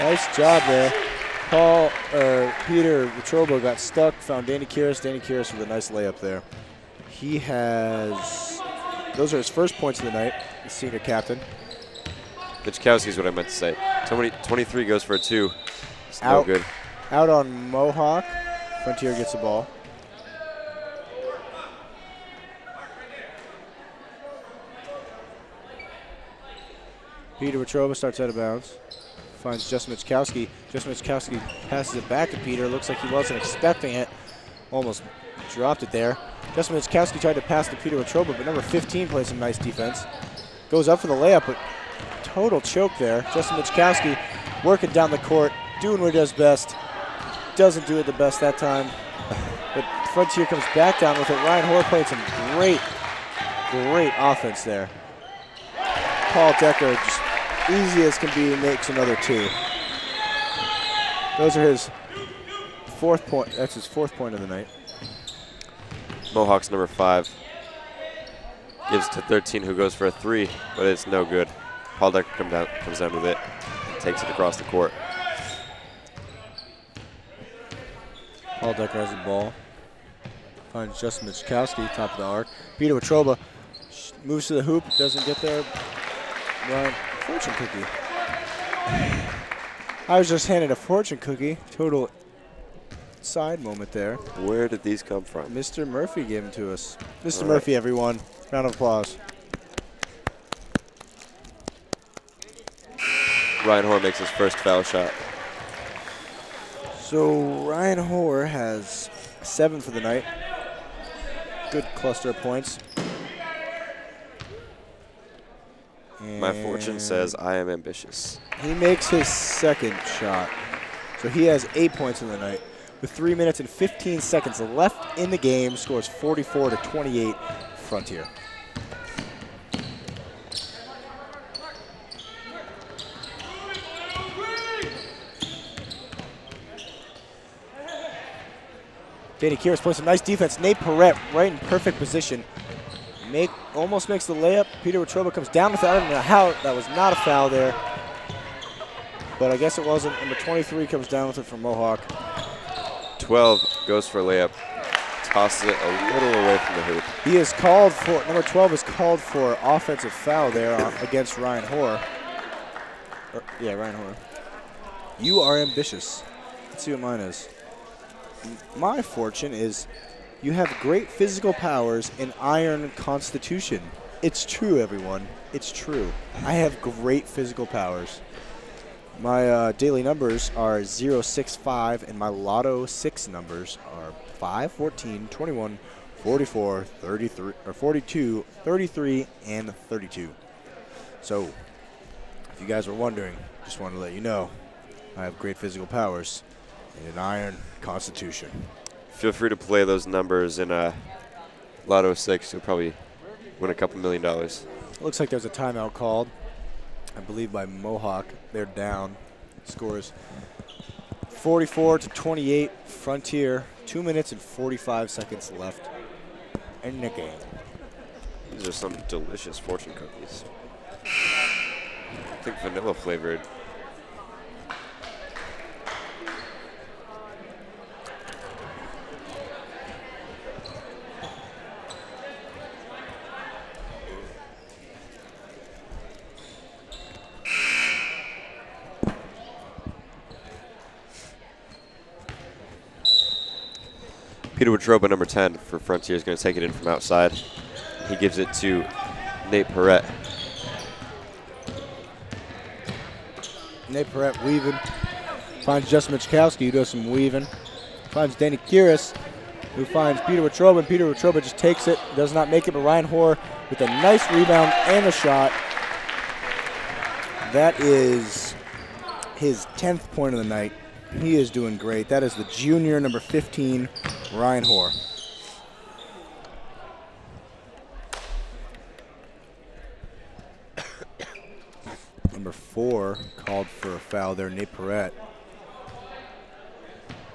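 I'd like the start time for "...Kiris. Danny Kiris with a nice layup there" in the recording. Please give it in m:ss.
0:04.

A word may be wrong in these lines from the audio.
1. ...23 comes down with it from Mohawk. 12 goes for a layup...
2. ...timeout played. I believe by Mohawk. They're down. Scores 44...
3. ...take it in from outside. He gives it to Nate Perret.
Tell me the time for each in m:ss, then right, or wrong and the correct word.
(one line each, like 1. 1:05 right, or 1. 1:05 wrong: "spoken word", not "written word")
1. 2:30 right
2. 3:25 wrong: "called", not "played"
3. 4:06 right.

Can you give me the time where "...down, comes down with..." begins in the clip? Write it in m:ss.
1:12.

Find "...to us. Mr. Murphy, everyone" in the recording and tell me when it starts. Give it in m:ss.
1:36.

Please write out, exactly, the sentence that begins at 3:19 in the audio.
Feel free to play those numbers in uh, Lotto 6.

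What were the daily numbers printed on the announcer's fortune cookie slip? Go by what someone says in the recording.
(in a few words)
065.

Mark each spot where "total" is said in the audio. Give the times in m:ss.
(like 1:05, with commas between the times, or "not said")
0:42, 1:31.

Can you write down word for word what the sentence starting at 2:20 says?
Nate Perret right in perfect position.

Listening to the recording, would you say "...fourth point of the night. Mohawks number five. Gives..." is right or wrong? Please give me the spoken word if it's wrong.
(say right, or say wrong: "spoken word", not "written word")
right.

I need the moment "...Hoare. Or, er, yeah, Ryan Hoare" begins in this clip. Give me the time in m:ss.
2:41.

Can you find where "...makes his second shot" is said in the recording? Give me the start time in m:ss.
1:58.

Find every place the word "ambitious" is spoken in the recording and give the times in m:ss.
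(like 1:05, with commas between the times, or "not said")
1:57, 2:45.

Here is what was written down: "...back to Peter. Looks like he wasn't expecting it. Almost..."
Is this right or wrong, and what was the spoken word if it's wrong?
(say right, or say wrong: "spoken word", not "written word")
right.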